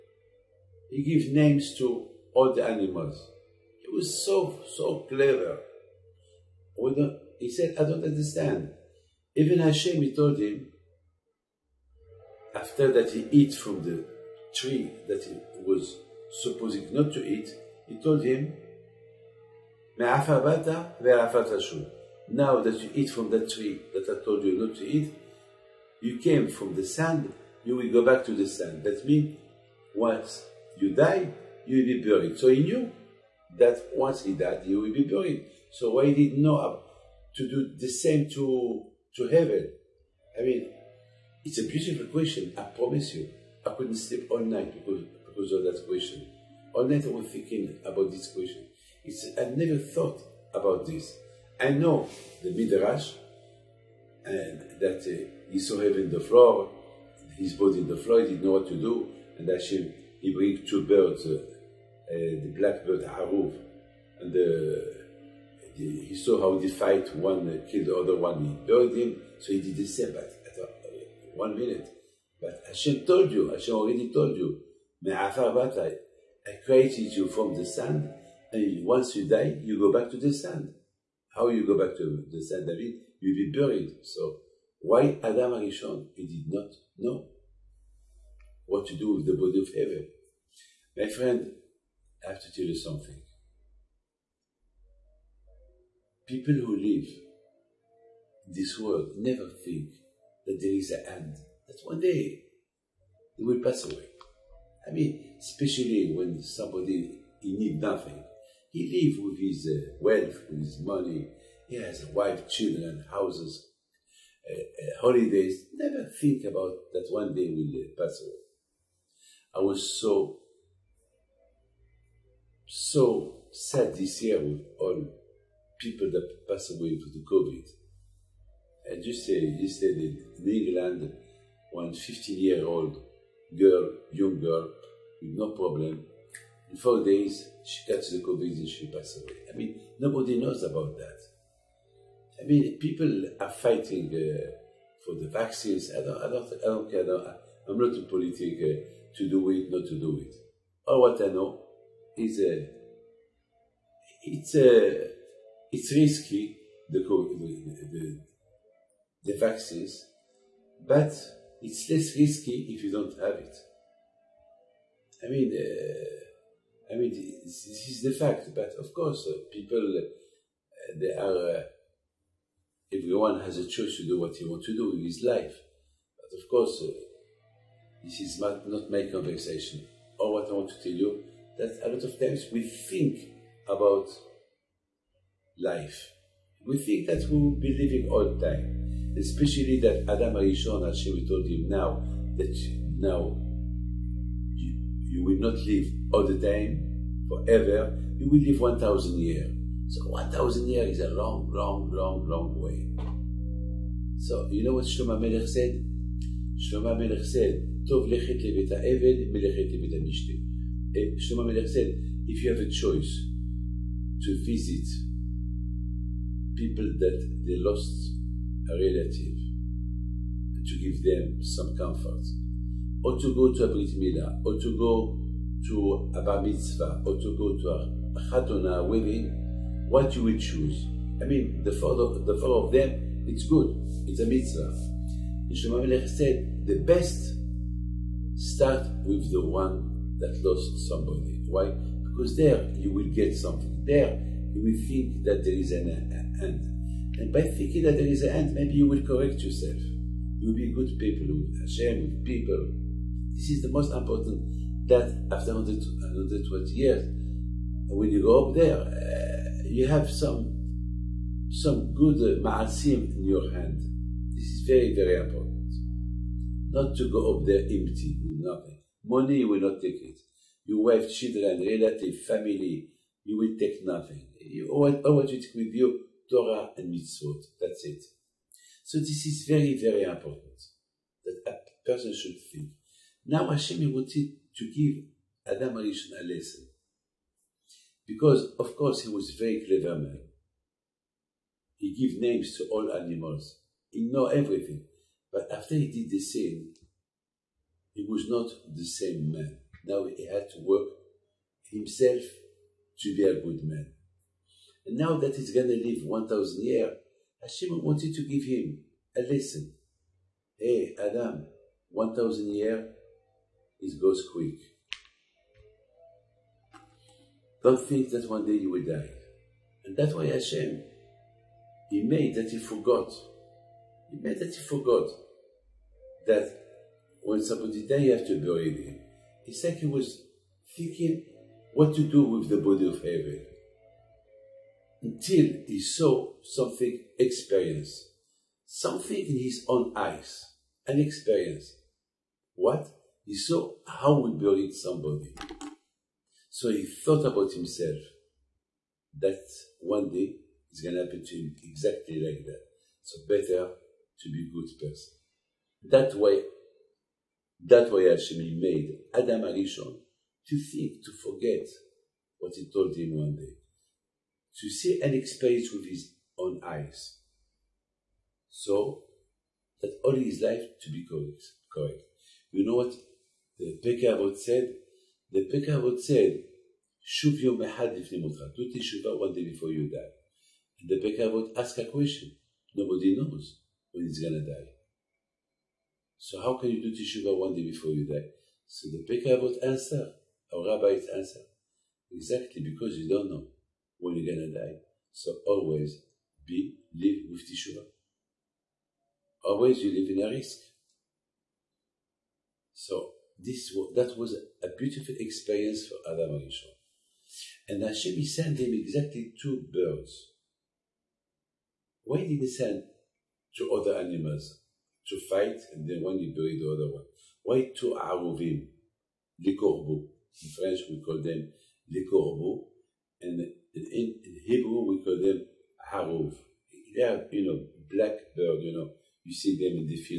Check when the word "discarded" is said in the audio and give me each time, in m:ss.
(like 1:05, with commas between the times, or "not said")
not said.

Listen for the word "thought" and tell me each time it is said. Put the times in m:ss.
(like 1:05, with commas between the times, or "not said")
0:49, 5:46.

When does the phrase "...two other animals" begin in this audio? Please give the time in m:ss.
6:53.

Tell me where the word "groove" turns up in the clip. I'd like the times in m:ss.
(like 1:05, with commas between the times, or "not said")
not said.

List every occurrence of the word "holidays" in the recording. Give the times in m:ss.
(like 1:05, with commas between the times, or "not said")
1:54.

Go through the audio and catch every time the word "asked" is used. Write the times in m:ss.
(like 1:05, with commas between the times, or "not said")
6:21.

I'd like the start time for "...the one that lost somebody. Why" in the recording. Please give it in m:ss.
3:59.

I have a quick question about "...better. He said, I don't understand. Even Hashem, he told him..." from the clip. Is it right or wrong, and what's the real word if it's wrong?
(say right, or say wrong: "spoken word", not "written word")
wrong: "clever", not "better".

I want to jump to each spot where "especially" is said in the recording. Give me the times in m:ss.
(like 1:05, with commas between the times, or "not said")
1:45, 3:09.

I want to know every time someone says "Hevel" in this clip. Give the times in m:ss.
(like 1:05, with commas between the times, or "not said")
0:39, 0:55, 1:29, 5:33.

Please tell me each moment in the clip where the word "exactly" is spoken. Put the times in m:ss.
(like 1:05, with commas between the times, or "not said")
5:51, 6:32, 6:48.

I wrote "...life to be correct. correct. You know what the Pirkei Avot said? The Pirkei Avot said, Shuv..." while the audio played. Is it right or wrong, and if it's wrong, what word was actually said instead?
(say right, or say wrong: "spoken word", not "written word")
right.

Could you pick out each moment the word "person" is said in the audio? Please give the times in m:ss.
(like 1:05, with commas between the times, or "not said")
4:41, 5:54.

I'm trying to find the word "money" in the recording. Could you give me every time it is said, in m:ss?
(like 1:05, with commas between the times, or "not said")
1:50, 4:29.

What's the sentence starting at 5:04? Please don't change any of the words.
And now that he's going to live 1,000 years, Hashem wanted to give him a lesson.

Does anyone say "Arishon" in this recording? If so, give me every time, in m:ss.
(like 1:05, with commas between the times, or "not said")
1:25, 3:10, 4:45, 5:59, 6:46.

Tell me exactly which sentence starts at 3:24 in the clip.
So you know what Shlomo Melech said?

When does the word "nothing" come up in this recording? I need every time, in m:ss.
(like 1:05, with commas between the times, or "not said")
1:47, 4:28, 4:33.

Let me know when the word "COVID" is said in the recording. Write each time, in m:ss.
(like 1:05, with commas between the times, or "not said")
2:07, 2:18.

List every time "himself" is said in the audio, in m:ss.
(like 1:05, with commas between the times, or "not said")
5:01, 5:47.